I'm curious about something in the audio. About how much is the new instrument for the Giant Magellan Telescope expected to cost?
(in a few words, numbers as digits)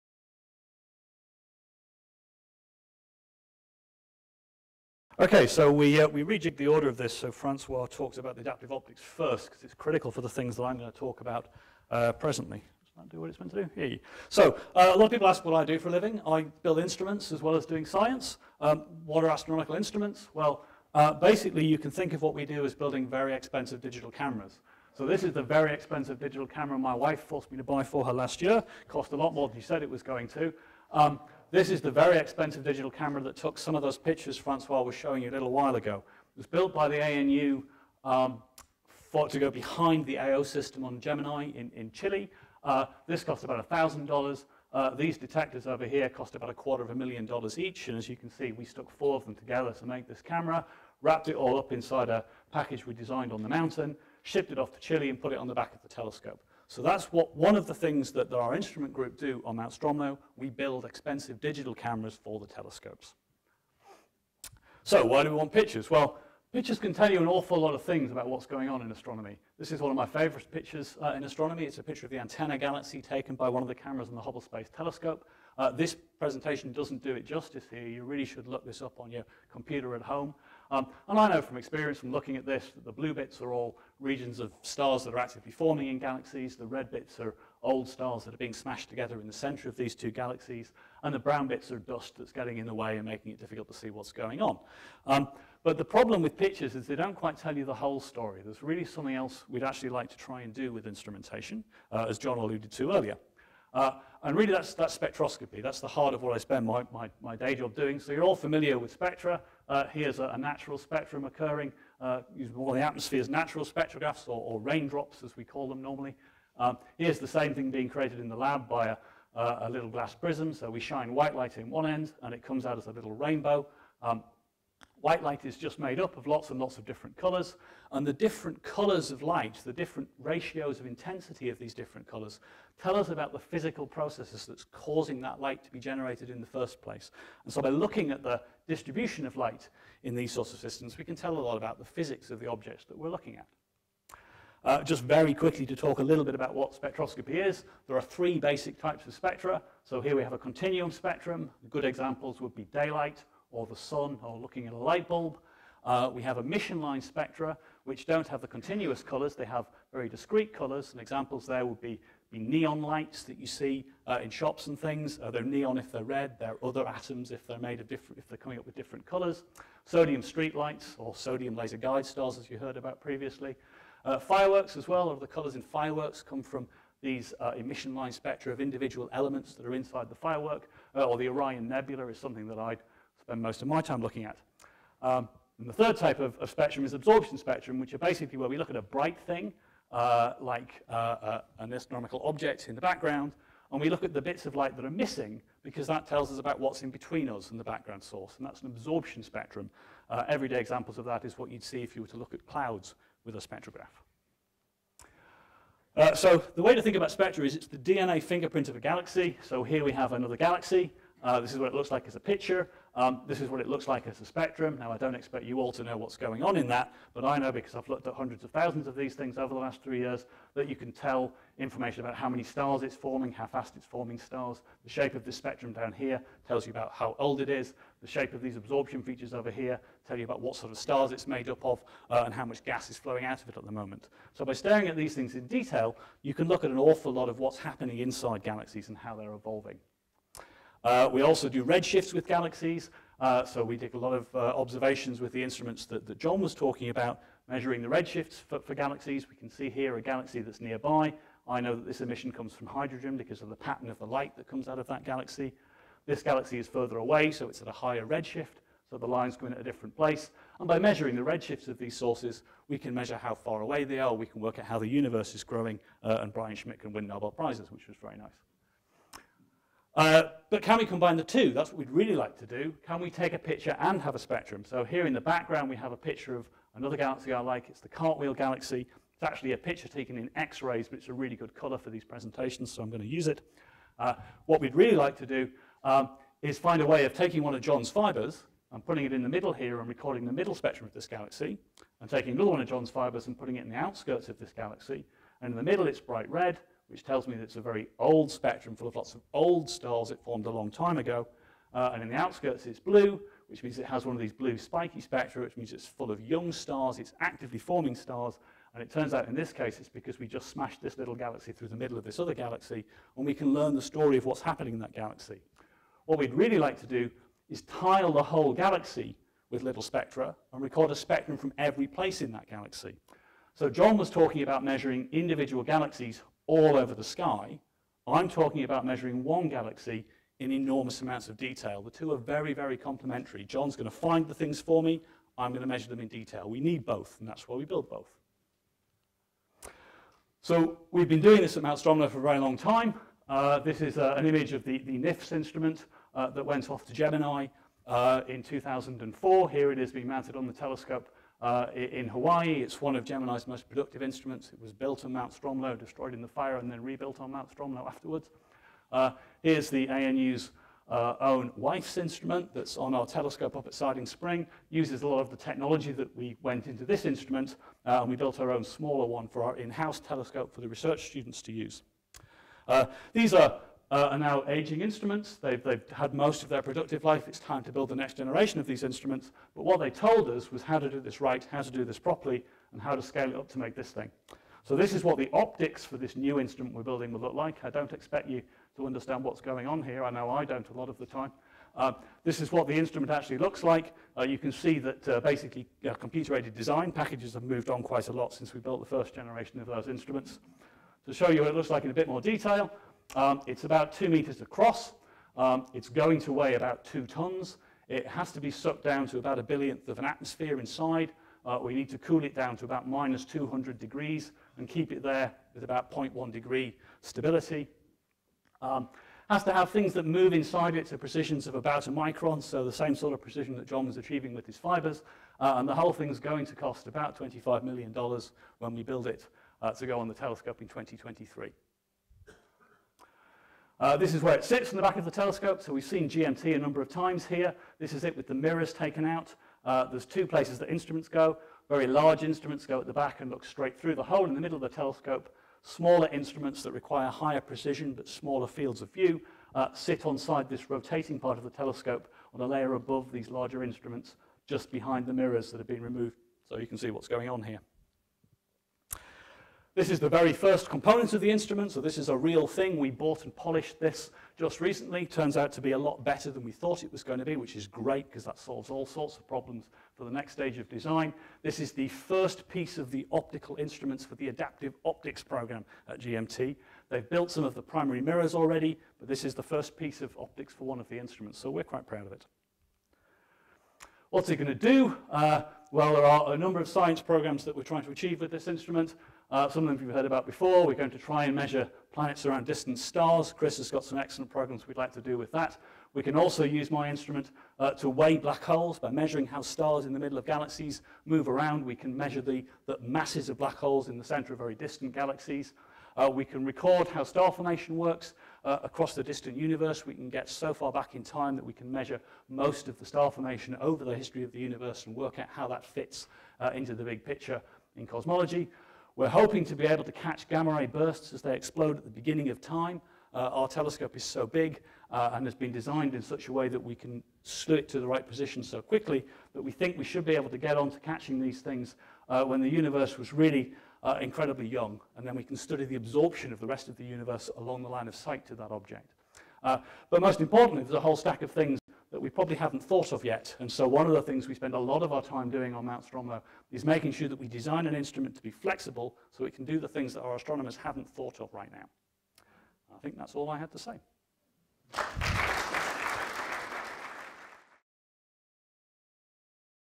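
$25 million.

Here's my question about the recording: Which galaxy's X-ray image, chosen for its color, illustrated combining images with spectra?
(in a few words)
Cartwheel Galaxy.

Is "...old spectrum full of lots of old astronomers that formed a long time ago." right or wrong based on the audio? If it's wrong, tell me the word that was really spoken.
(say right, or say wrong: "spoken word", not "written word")
wrong: "stars", not "astronomers".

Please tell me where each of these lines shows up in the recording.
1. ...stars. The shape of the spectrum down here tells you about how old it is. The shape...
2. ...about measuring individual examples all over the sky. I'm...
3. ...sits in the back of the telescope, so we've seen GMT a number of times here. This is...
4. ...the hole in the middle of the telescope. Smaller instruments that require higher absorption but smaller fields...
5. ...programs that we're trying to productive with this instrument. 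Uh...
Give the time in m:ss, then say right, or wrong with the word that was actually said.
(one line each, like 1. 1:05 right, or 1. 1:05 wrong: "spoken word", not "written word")
1. 3:44 right
2. 5:24 wrong: "galaxies", not "examples"
3. 7:14 right
4. 7:23 wrong: "precision", not "absorption"
5. 8:07 wrong: "achieve", not "productive".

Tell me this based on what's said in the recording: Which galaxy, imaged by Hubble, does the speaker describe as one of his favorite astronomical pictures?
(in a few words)
Antenna galaxy.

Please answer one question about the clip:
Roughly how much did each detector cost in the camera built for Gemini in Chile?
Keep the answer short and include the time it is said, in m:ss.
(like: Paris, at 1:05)
a quarter of a million dollars, at 0:46.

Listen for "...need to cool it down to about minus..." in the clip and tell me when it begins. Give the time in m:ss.
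6:51.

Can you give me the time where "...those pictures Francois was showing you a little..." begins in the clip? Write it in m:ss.
0:33.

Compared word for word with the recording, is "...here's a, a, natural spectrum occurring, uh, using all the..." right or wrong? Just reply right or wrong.
right.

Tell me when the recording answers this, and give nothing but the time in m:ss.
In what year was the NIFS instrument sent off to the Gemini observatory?
5:48.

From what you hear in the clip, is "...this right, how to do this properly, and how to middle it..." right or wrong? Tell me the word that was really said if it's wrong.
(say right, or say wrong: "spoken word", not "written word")
wrong: "scale", not "middle".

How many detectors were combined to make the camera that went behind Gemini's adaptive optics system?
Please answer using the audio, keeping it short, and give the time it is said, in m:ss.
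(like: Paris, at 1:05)
4, at 0:48.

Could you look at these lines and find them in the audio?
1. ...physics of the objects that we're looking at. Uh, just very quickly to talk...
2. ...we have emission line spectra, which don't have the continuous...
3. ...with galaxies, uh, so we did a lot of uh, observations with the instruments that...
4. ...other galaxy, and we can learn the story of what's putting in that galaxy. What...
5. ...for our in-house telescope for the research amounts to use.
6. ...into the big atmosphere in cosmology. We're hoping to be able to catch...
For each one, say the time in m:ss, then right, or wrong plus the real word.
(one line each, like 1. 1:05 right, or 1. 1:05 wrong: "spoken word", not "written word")
1. 2:21 right
2. 2:36 right
3. 4:02 right
4. 5:12 wrong: "happening", not "putting"
5. 6:09 wrong: "students", not "amounts"
6. 8:36 wrong: "picture", not "atmosphere".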